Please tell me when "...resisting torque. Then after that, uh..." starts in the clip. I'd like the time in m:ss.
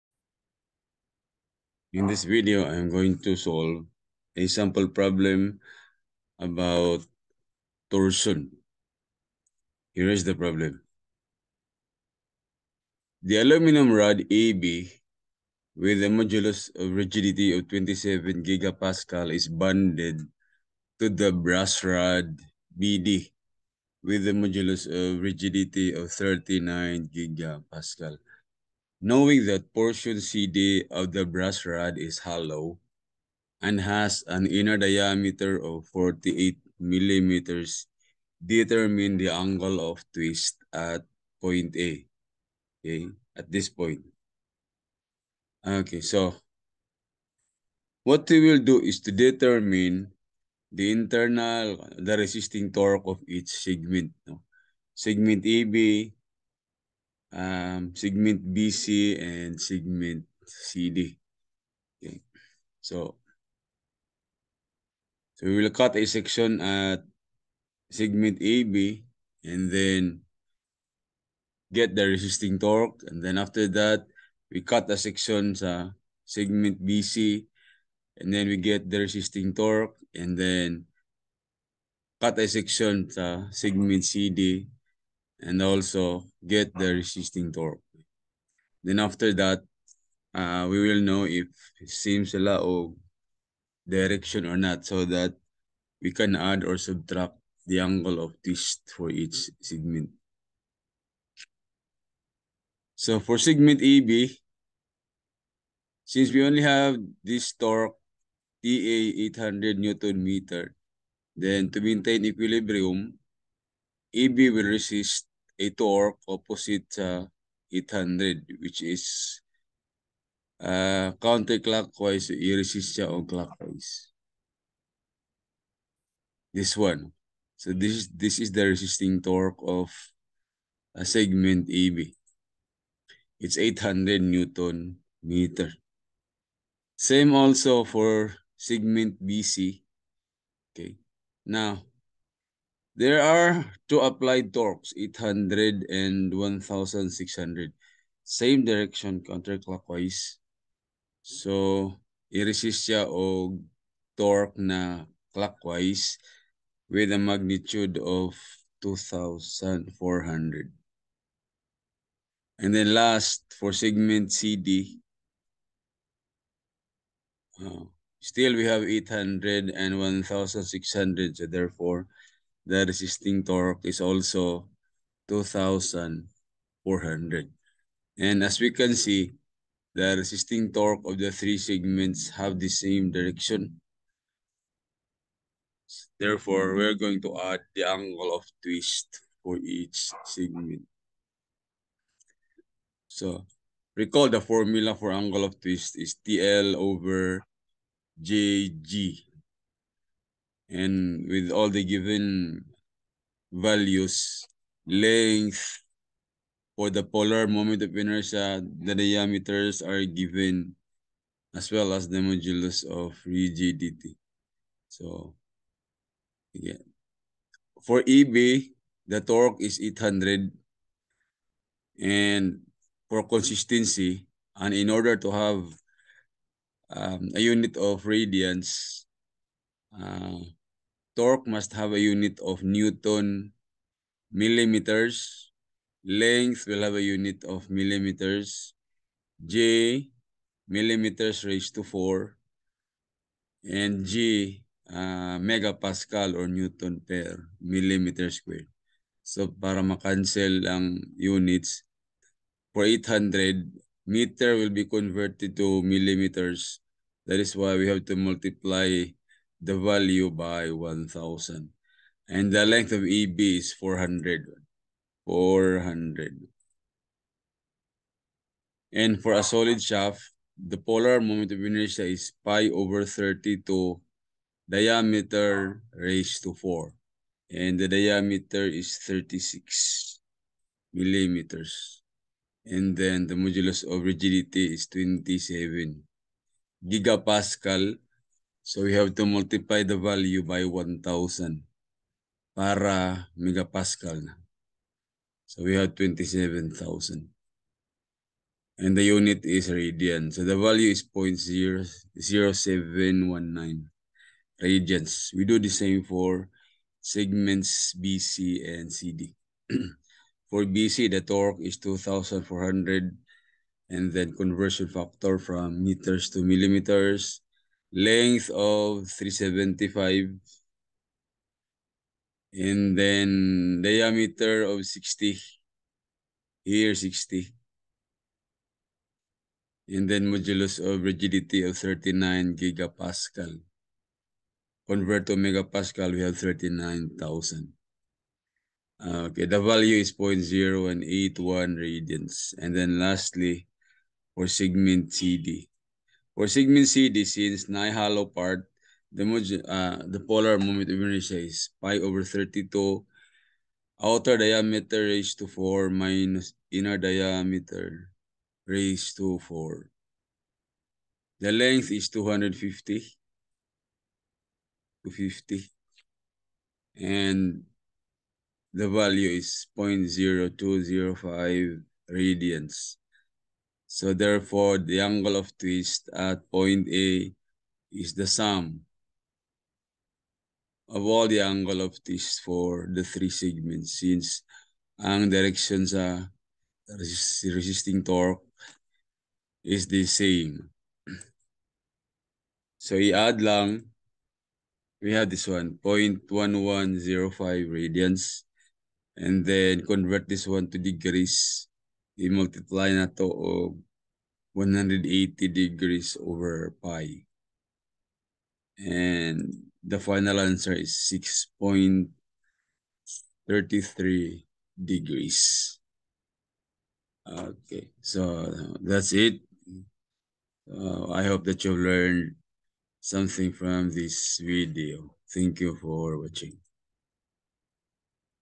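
1:26.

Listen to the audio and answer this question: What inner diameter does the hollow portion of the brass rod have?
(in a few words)
48 mm.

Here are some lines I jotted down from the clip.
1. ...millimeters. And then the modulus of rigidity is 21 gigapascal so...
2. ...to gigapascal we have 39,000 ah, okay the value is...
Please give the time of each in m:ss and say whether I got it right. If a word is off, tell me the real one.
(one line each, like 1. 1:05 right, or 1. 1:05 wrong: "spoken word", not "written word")
1. 4:40 wrong: "27", not "21"
2. 5:35 wrong: "megapascal", not "gigapascal".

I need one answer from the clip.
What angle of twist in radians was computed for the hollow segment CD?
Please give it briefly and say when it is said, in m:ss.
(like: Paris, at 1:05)
0.0205 radians, at 6:10.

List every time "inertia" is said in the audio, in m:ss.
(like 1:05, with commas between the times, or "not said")
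3:27, 4:31, 5:50.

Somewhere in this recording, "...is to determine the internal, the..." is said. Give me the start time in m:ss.
0:48.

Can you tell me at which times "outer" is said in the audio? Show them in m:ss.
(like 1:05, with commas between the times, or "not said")
5:54.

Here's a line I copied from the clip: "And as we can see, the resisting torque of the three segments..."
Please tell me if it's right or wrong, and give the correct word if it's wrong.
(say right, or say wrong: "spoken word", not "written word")
right.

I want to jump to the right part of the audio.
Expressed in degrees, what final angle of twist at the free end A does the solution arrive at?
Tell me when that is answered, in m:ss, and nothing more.
6:51.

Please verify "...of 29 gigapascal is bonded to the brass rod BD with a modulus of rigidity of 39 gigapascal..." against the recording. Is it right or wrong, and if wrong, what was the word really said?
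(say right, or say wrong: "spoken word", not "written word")
wrong: "27", not "29".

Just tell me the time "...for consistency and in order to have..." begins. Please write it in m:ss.
3:43.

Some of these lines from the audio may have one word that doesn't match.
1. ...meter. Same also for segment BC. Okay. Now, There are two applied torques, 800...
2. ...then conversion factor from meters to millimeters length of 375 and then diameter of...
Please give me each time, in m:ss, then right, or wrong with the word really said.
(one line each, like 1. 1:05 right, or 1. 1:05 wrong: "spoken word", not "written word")
1. 2:15 right
2. 5:14 right.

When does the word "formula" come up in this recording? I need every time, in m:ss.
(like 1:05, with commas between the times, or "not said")
3:14.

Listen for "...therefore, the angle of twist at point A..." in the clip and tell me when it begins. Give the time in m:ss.
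6:14.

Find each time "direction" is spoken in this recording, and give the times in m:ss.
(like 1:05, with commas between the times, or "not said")
1:33, 2:28, 3:03, 6:25.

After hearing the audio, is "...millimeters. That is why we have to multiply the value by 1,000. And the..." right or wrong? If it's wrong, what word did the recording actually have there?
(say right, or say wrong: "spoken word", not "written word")
right.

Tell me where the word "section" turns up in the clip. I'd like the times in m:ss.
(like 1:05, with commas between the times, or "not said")
1:06, 1:14, 1:22.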